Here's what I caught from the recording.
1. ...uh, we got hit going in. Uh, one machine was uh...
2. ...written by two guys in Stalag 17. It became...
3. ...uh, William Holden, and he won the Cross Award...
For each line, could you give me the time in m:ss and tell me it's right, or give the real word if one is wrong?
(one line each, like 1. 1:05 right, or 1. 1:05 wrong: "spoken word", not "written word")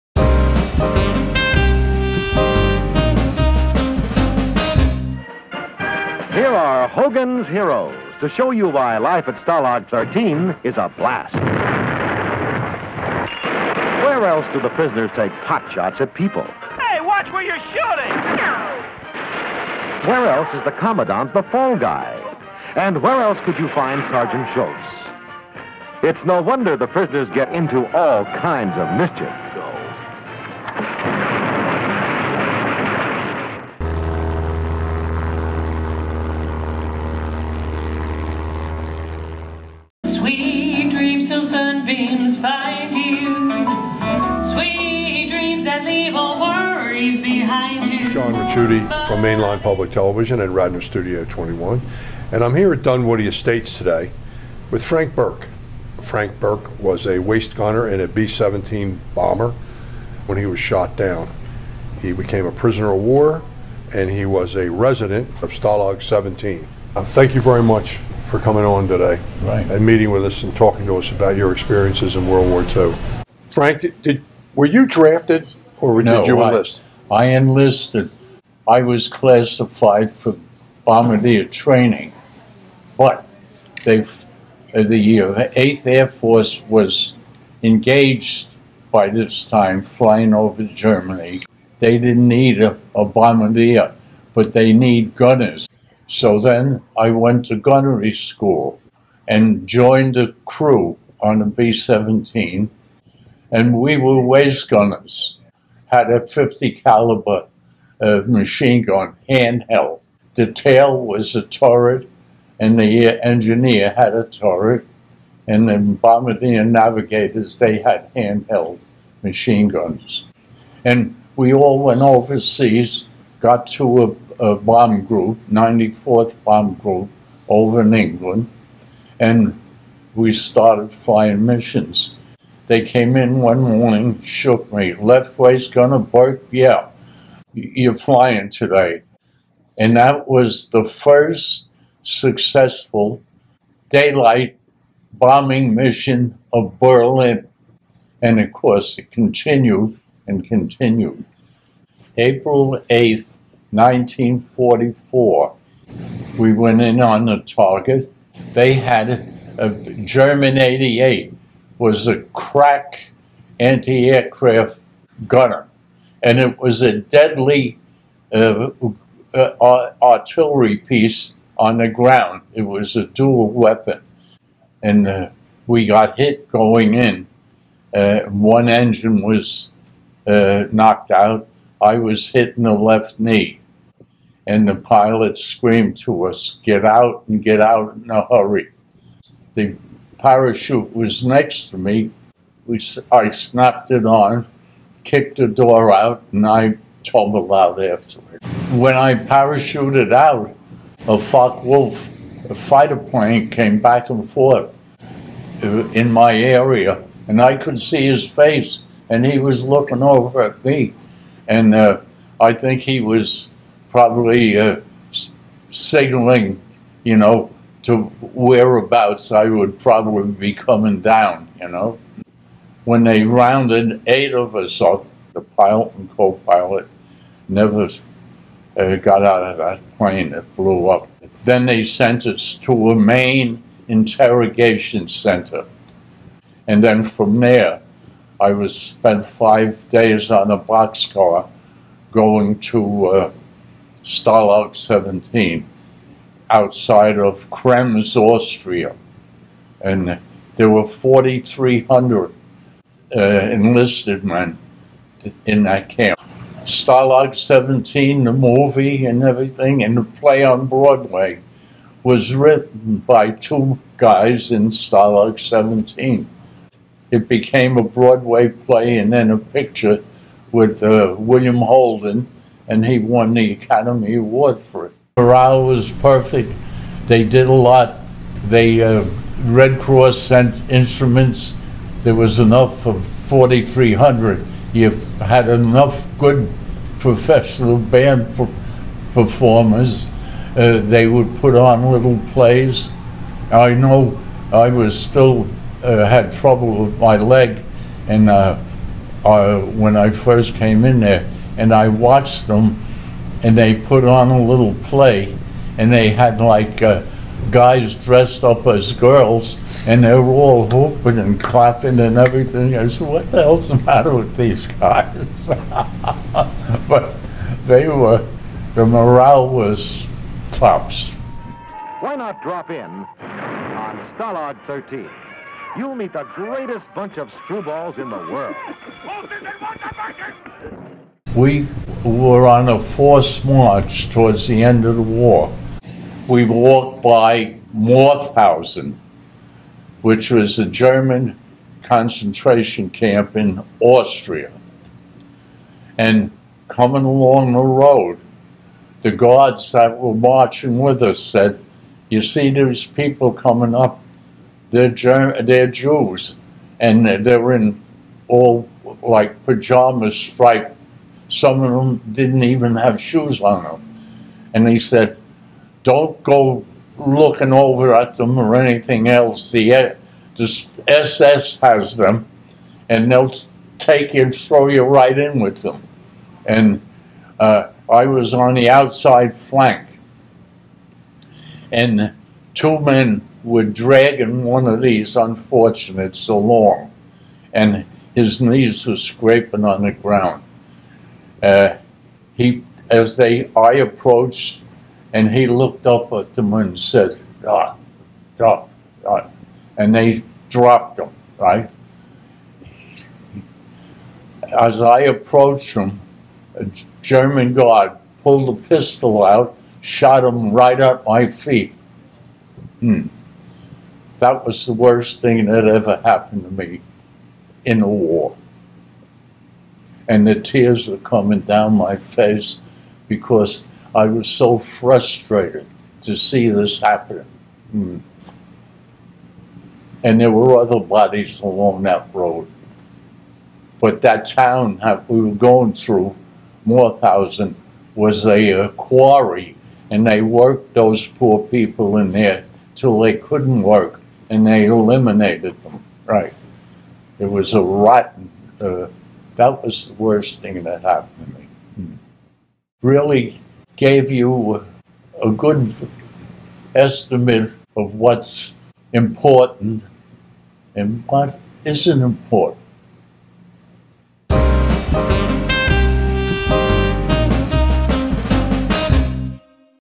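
1. 2:55 wrong: "engine", not "machine"
2. 4:22 right
3. 4:30 wrong: "Academy", not "Cross".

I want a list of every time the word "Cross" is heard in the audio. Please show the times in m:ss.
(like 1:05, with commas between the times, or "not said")
4:39.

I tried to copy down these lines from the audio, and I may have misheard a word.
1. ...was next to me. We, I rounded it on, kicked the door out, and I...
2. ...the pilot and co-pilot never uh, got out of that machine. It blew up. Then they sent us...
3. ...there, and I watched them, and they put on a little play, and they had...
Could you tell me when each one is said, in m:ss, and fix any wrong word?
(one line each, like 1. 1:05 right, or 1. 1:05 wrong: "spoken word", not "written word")
1. 3:10 wrong: "snapped", not "rounded"
2. 3:45 wrong: "plane", not "machine"
3. 5:00 right.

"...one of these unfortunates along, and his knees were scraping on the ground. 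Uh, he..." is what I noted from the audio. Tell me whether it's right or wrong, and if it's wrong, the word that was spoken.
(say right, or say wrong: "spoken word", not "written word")
right.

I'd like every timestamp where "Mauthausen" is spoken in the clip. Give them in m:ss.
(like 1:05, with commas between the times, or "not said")
5:37, 7:16.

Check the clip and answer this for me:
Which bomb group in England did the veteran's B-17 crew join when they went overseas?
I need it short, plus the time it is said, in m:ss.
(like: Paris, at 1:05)
94th, at 2:05.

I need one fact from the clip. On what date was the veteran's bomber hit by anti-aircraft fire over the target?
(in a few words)
April 8th, 1944.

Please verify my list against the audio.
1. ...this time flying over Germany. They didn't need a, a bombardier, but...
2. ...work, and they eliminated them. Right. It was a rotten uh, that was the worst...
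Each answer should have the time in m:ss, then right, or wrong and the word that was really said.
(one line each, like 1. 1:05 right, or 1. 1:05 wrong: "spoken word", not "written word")
1. 1:29 right
2. 7:23 right.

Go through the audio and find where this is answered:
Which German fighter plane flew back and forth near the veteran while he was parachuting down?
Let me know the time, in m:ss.
3:21.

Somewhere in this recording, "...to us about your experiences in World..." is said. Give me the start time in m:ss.
1:10.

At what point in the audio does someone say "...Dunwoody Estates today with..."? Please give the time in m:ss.
0:52.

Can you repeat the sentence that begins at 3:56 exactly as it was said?
And then from there, I was spent five days on a boxcar going to uh, Stalag 17 outside of Krems, Austria.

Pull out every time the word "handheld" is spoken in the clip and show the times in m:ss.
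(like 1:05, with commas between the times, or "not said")
1:49, 1:58.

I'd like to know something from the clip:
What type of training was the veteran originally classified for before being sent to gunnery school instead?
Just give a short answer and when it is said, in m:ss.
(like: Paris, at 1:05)
Bombardier training, at 1:20.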